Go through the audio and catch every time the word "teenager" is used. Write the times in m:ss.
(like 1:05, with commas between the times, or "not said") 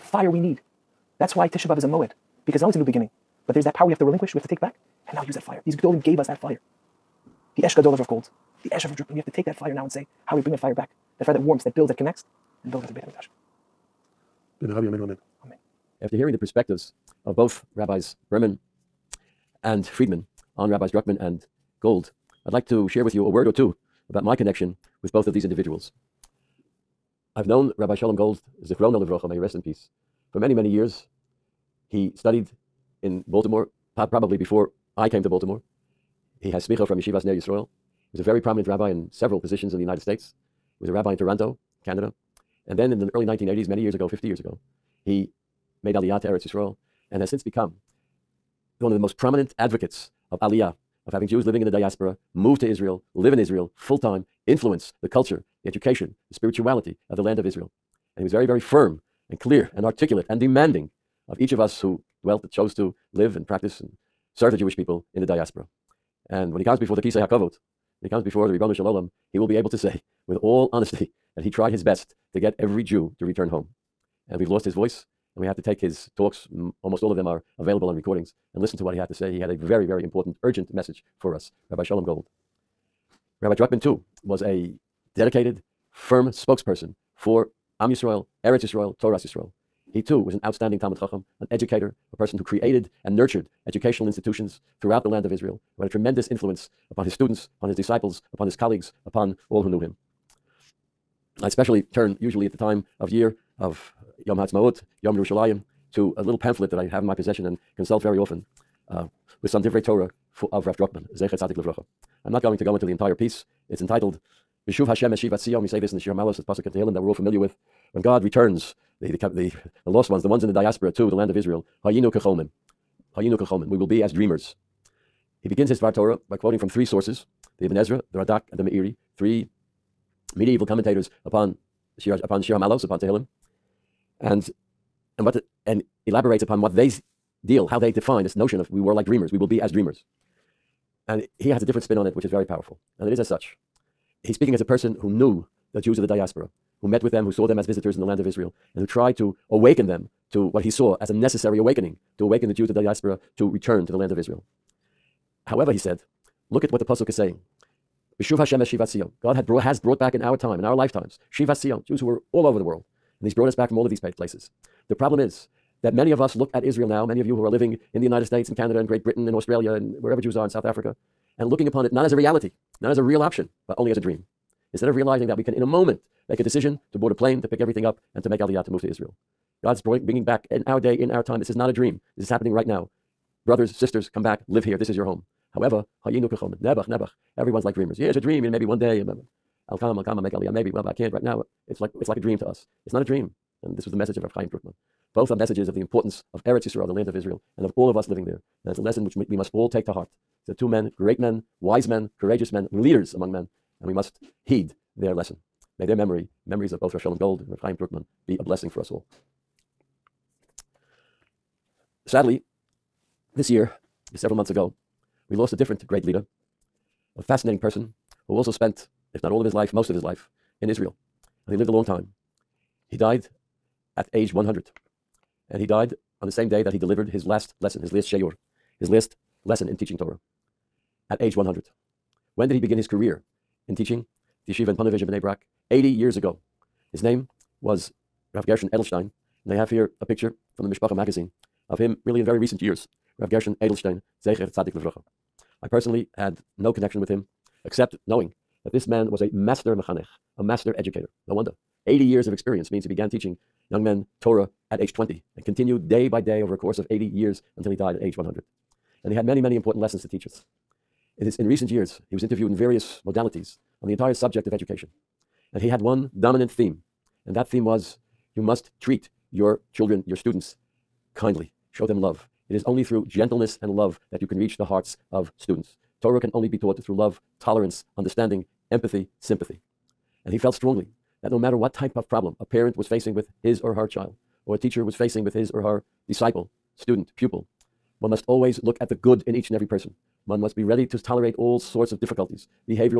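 not said.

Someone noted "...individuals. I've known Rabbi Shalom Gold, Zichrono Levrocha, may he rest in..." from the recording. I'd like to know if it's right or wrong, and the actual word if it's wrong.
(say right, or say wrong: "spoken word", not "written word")
right.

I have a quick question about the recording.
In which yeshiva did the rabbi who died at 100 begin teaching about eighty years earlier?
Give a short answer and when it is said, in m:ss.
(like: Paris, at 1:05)
Ponevezh, at 3:54.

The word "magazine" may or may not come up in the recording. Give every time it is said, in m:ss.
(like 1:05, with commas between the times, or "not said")
4:00.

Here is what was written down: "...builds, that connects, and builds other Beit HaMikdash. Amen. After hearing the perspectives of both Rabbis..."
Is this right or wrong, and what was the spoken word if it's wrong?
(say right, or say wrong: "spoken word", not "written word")
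right.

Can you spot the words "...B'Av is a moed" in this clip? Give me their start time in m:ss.
0:01.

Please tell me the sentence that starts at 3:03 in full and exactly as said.
Brothers, sisters, come back, live here.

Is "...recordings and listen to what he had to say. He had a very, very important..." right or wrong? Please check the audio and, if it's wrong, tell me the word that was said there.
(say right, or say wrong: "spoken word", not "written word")
right.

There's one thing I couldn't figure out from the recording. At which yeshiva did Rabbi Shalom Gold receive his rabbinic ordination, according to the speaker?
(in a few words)
Ner Yisrael.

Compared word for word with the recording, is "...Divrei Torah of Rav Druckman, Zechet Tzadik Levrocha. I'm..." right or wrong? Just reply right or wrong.
right.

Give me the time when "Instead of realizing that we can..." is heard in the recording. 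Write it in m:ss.
2:54.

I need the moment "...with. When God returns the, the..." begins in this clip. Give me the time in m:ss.
1:57.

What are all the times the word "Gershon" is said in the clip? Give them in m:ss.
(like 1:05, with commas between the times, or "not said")
3:58, 4:03.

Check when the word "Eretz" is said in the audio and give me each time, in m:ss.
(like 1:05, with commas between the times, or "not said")
0:46, 1:28, 3:16.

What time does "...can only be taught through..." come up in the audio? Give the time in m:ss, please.
4:36.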